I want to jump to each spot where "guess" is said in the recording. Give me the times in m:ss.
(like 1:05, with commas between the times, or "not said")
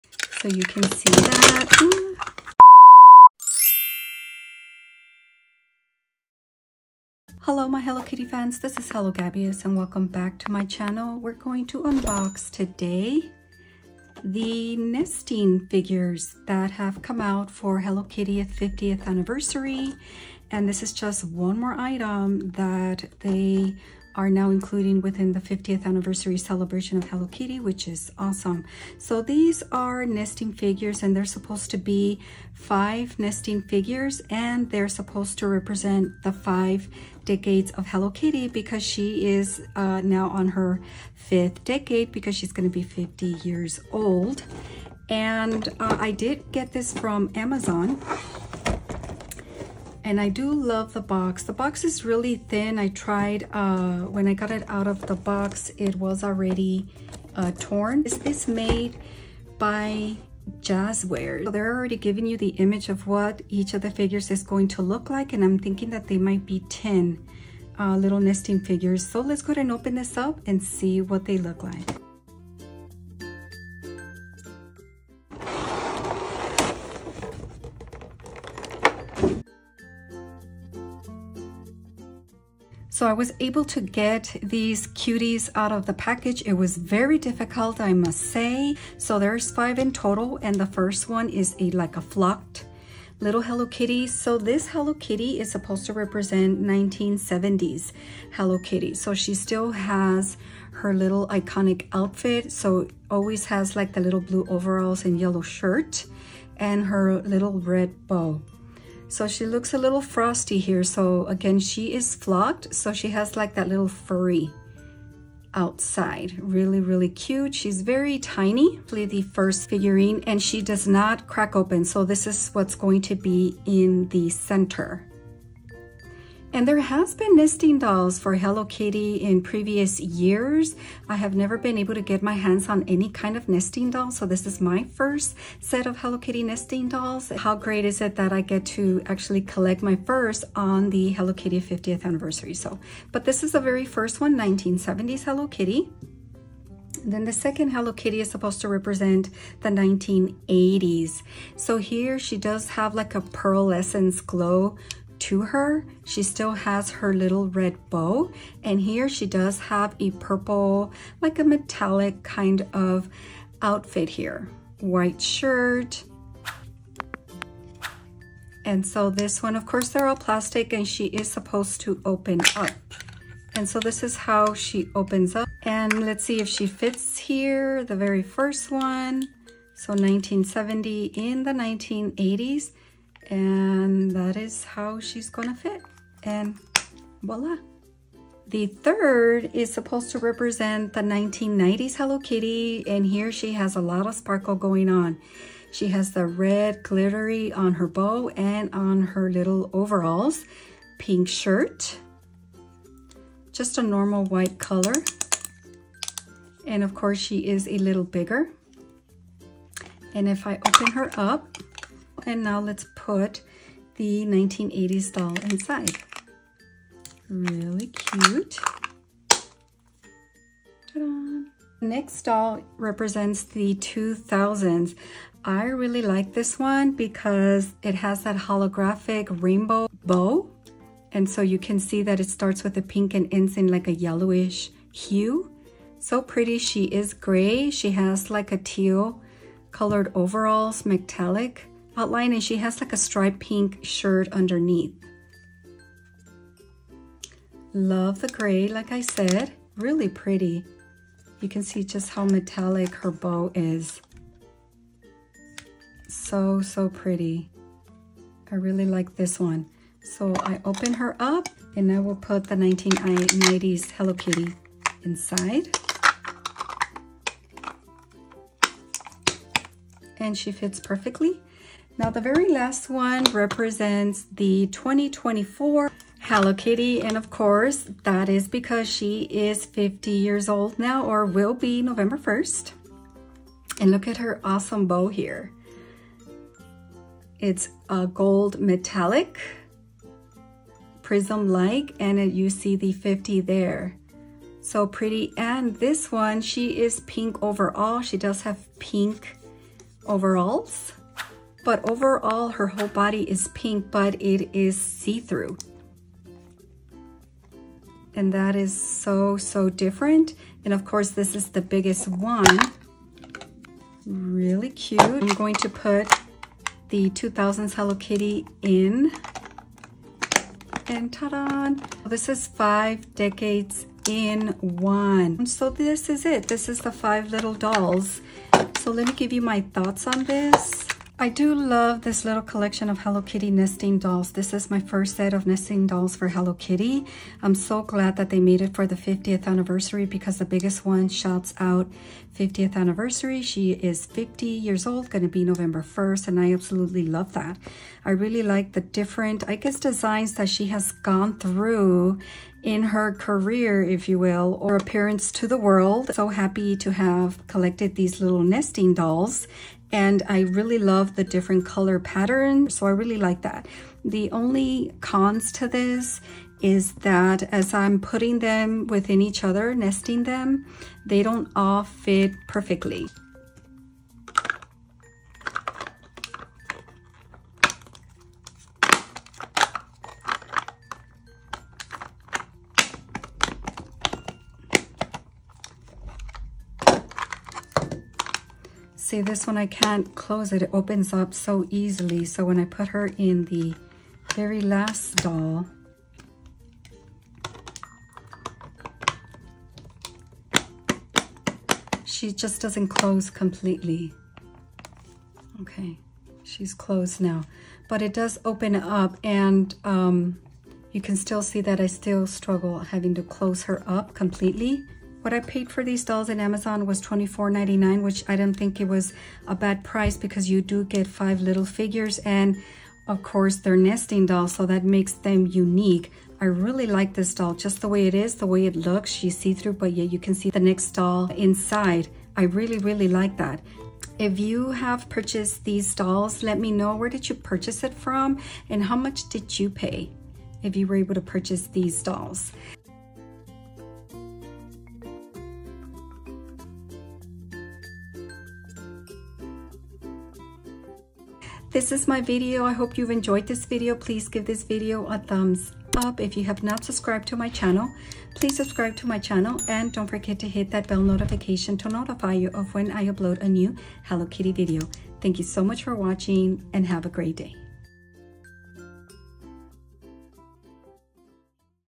5:49.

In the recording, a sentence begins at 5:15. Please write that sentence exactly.
I'm going to put the 2000s Hello Kitty in.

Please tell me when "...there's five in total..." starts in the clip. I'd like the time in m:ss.
1:29.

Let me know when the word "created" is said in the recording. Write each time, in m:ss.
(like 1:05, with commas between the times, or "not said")
not said.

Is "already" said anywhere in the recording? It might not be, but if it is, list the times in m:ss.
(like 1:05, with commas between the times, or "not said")
0:56, 1:01.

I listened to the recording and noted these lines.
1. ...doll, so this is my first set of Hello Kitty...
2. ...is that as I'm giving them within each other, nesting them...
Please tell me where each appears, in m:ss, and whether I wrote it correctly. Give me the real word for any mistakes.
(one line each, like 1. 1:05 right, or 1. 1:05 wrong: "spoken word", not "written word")
1. 2:13 right
2. 6:06 wrong: "putting", not "giving".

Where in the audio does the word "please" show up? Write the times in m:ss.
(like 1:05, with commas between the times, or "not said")
7:33, 7:38.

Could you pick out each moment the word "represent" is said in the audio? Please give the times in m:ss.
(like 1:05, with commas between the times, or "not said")
0:35, 1:35, 2:28, 3:10, 3:42, 4:33.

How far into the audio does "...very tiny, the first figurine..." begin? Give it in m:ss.
1:57.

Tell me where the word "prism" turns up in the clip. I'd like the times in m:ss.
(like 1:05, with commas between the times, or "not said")
4:51.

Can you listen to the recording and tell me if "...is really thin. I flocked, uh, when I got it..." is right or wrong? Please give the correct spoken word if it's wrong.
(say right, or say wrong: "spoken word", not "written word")
wrong: "tried", not "flocked".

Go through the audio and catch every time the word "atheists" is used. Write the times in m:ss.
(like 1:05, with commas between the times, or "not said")
not said.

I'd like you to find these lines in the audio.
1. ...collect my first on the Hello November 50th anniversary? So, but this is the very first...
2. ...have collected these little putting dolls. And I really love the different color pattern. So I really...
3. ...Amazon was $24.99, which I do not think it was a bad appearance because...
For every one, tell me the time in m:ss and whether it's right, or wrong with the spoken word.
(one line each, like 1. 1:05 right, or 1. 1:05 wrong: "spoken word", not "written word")
1. 2:19 wrong: "Kitty", not "November"
2. 5:56 wrong: "nesting", not "putting"
3. 6:56 wrong: "price", not "appearance".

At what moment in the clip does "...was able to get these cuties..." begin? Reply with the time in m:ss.
1:23.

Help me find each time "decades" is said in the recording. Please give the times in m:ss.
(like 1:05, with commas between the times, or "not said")
0:37, 0:41, 5:23.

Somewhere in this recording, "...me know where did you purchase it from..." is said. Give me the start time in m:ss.
7:16.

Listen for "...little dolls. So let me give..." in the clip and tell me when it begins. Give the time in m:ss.
5:27.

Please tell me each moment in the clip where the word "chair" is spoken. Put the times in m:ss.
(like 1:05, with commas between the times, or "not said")
not said.